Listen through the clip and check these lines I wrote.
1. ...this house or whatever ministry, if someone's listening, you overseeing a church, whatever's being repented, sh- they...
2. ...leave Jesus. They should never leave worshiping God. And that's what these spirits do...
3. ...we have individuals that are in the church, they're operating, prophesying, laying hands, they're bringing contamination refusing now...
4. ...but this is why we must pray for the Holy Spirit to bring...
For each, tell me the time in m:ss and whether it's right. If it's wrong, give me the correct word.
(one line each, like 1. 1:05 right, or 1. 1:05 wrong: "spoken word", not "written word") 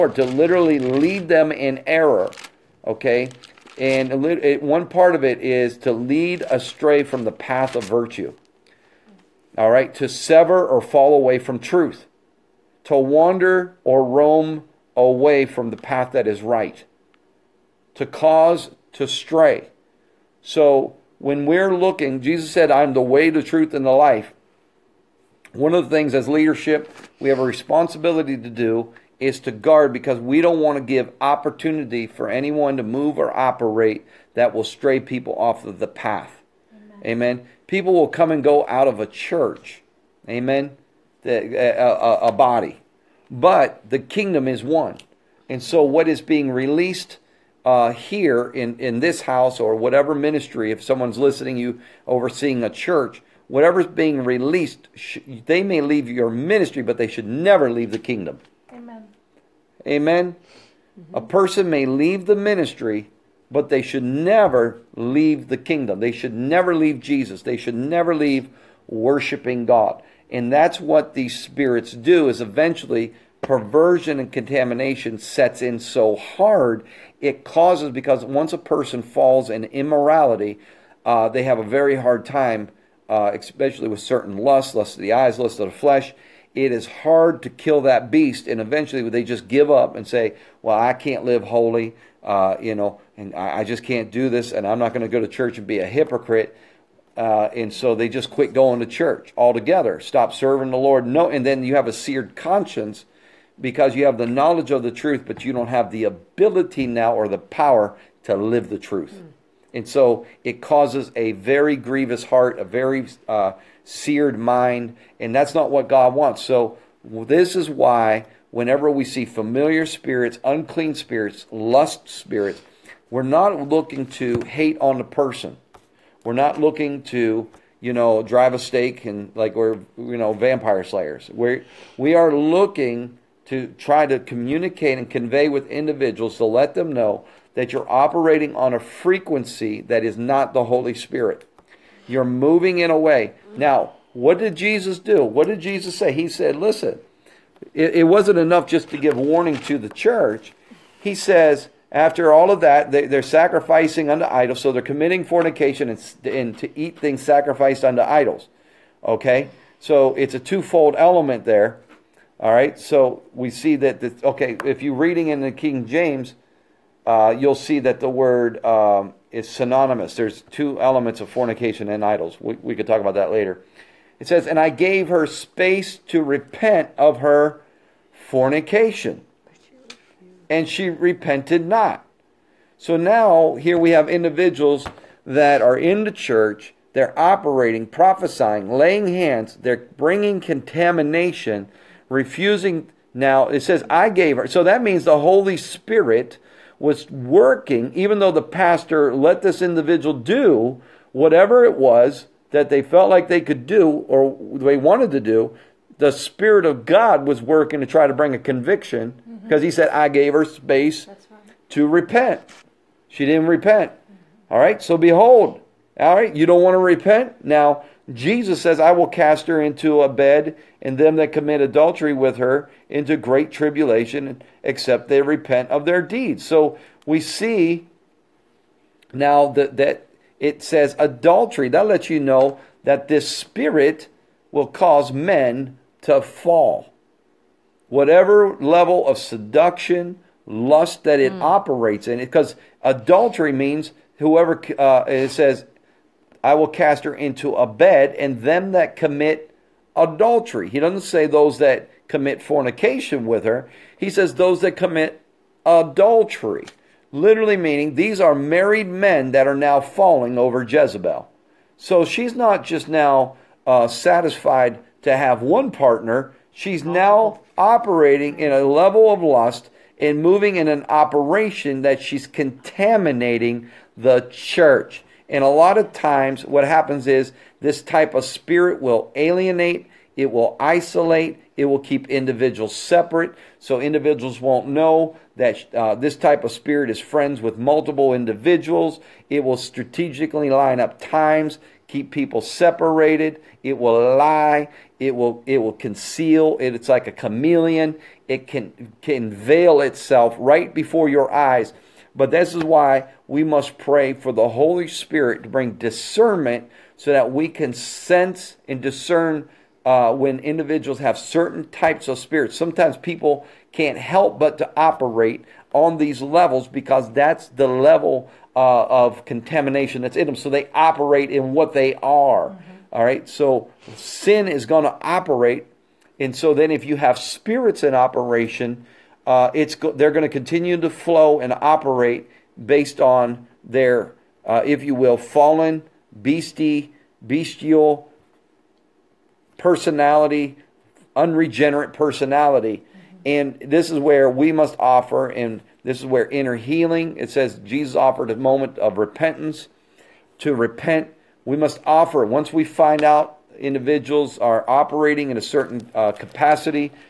1. 0:49 wrong: "released", not "repented"
2. 1:06 right
3. 3:03 right
4. 5:02 right.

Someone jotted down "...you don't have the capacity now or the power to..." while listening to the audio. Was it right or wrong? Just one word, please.
wrong.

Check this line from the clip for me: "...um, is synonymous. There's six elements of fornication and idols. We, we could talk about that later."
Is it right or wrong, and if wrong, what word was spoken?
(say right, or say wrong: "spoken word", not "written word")
wrong: "two", not "six".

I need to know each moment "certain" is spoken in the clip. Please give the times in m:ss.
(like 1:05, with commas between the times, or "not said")
1:24, 5:11, 5:55.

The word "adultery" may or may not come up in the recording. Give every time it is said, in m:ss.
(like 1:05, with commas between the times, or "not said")
3:41, 3:50, 4:02, 4:09, 4:15.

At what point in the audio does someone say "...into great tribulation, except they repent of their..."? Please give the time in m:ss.
3:42.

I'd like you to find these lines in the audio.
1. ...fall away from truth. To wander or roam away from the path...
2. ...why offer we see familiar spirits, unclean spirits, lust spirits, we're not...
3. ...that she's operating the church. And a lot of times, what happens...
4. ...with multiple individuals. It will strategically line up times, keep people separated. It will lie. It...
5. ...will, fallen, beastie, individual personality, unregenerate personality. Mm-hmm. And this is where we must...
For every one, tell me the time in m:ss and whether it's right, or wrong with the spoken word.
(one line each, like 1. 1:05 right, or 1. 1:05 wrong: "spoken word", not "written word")
1. 0:10 right
2. 1:57 wrong: "whenever", not "offer"
3. 4:31 wrong: "contaminating", not "operating"
4. 4:47 right
5. 5:34 wrong: "bestial", not "individual".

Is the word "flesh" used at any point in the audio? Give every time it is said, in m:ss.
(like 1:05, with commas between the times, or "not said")
1:25.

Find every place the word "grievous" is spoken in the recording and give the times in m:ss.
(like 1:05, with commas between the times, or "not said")
1:51.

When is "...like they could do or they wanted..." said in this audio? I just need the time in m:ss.
3:23.